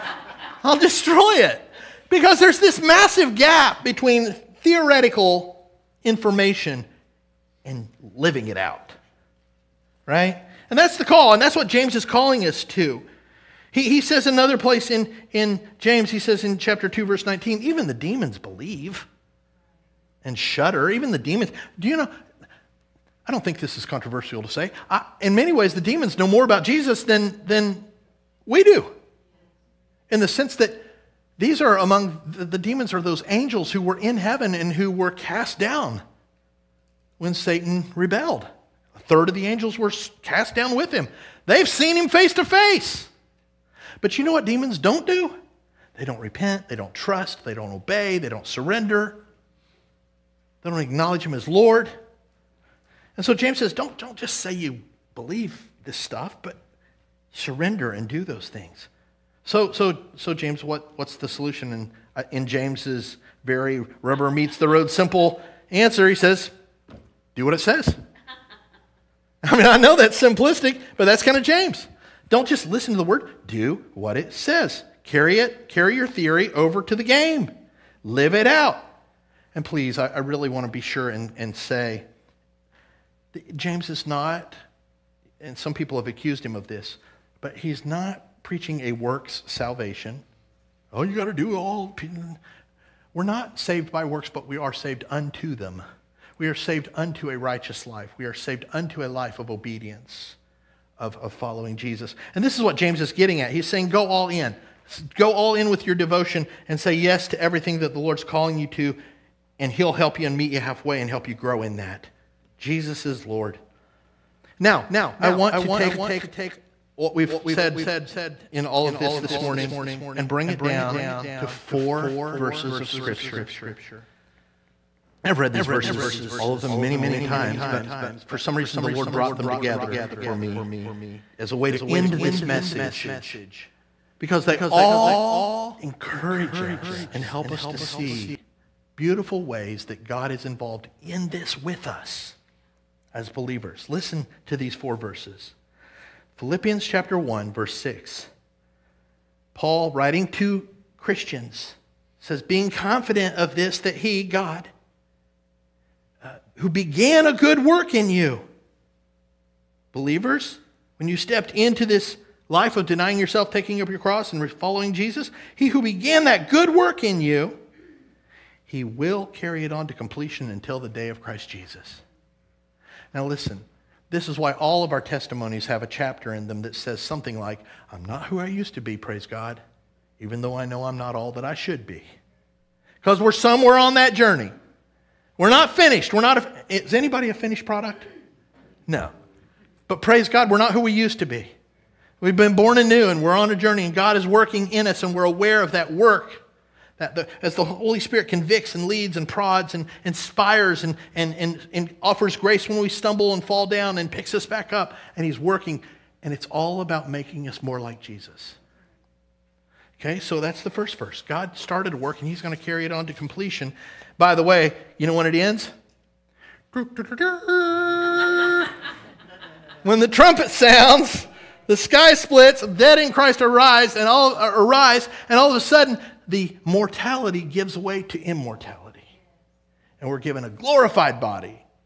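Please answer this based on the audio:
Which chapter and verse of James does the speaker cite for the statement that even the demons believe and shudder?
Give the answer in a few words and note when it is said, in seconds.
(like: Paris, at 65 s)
Chapter 2, verse 19, at 16 s.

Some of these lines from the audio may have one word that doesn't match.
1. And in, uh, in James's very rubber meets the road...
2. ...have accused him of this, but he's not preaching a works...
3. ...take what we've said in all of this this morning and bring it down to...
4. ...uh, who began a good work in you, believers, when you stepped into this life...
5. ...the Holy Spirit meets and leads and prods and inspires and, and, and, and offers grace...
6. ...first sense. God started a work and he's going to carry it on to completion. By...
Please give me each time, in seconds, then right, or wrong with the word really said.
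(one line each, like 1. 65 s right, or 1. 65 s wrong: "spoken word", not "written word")
1. 61 s right
2. 85 s right
3. 115 s right
4. 156 s right
5. 197 s wrong: "convicts", not "meets"
6. 210 s wrong: "verse", not "sense".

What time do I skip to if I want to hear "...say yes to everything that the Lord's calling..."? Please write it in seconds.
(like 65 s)
106 s.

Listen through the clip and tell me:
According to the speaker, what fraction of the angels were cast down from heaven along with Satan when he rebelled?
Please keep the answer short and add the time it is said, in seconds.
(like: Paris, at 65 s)
A third, at 38 s.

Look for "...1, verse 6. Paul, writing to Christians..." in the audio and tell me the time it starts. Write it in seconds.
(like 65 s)
147 s.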